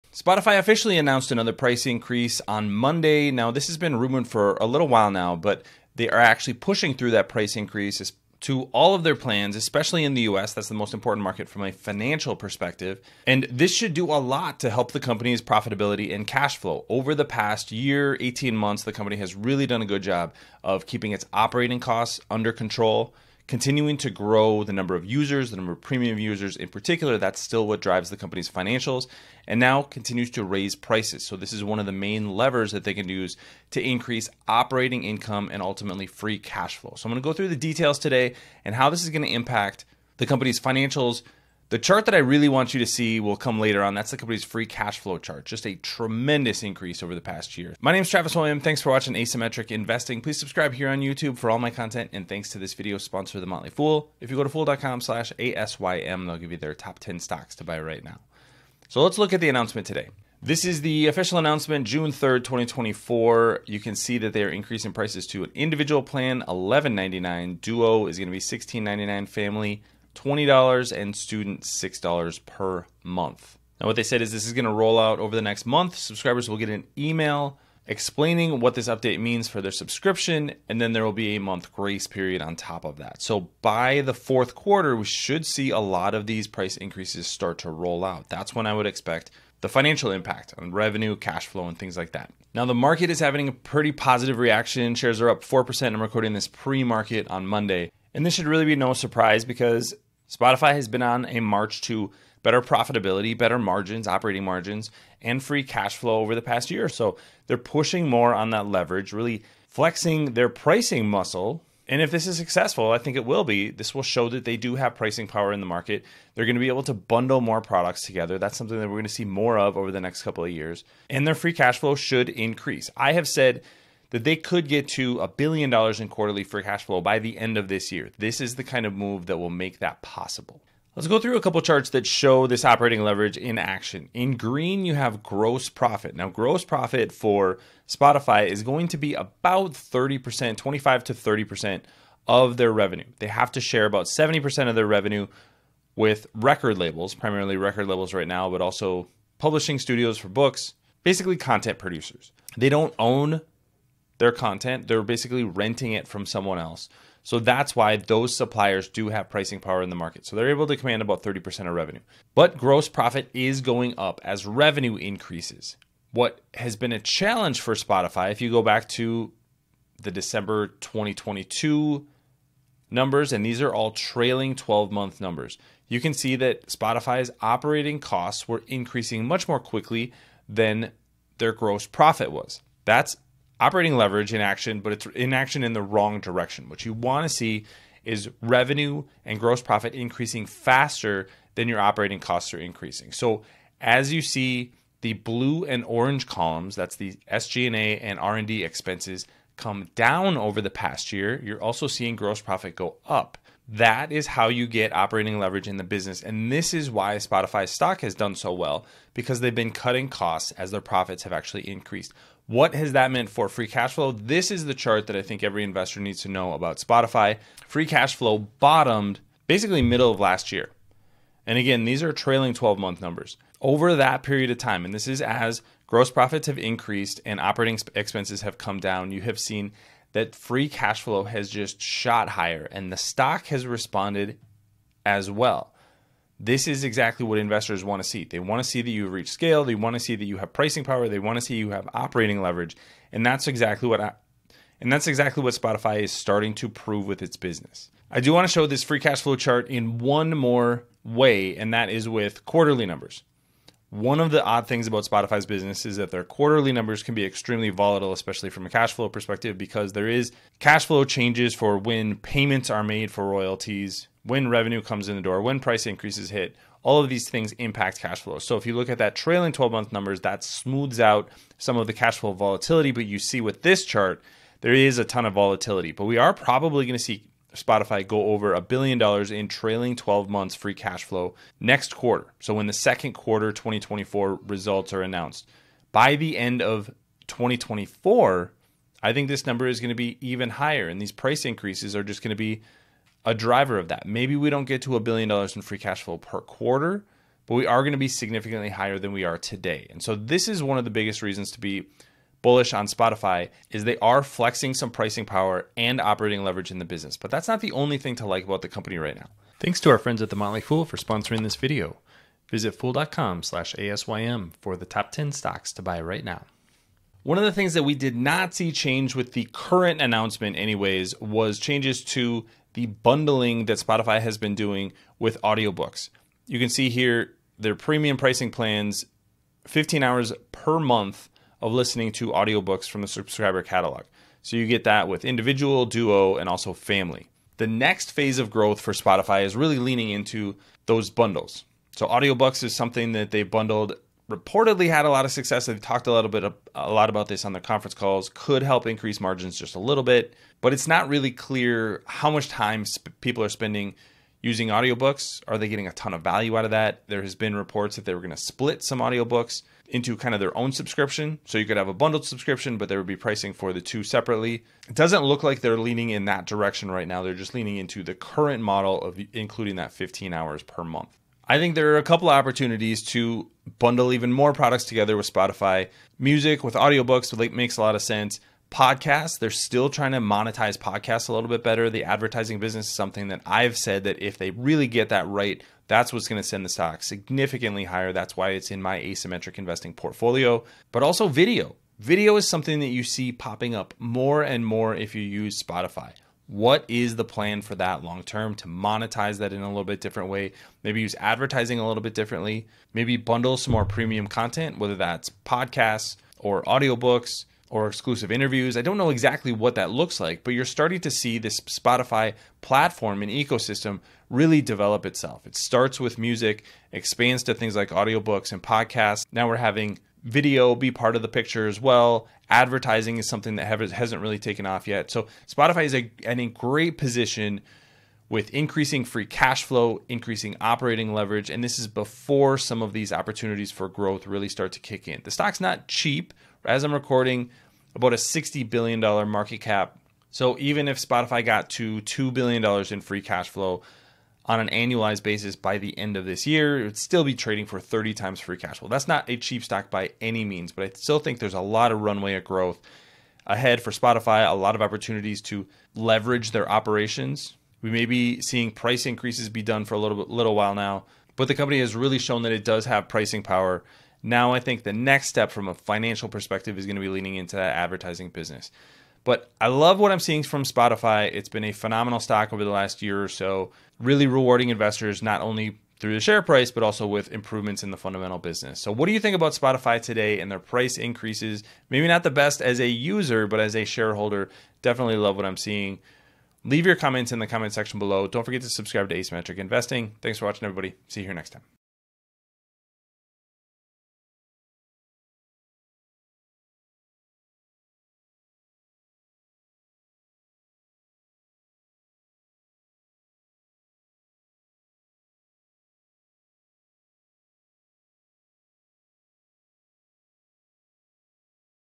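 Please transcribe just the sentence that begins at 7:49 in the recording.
But I love what I'm seeing from Spotify.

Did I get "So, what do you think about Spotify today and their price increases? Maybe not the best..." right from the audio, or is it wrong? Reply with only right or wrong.
right.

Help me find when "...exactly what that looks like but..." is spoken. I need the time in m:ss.
6:49.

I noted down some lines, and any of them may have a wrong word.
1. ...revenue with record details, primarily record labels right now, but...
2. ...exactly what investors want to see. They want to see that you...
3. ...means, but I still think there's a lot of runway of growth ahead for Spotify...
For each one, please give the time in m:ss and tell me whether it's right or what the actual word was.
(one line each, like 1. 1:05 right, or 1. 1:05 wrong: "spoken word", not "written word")
1. 2:24 wrong: "labels", not "details"
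2. 3:56 right
3. 7:30 right.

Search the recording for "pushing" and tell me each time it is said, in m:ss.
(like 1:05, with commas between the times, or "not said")
0:06, 1:47.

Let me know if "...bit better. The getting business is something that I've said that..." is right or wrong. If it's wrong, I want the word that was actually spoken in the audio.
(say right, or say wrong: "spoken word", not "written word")
wrong: "advertising", not "getting".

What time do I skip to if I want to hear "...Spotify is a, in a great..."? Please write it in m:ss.
7:05.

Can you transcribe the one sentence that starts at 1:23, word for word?
So by the fourth quarter, we should see a lot of these price increases start to roll out.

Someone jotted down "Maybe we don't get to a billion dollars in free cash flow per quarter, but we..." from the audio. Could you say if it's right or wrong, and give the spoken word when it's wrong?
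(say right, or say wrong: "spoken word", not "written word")
right.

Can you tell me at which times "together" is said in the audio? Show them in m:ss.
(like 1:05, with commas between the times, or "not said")
1:58, 6:14.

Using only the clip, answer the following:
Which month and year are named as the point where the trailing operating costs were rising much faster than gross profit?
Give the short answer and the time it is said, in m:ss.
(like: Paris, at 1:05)
December 2022, at 2:50.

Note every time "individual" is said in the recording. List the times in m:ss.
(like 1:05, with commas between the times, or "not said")
1:05, 5:35.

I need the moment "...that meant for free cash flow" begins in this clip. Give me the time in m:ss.
3:32.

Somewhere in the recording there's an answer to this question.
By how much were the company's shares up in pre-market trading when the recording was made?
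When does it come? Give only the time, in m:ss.
1:35.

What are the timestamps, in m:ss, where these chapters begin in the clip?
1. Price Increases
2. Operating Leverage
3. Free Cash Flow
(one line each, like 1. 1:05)
1. 1:00
2. 2:10
3. 3:34.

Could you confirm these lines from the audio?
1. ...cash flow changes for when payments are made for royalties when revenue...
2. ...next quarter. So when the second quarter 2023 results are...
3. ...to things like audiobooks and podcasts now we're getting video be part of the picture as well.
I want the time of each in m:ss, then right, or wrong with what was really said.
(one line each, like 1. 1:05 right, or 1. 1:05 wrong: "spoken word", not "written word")
1. 4:20 right
2. 4:41 wrong: "2024", not "2023"
3. 6:57 wrong: "having", not "getting".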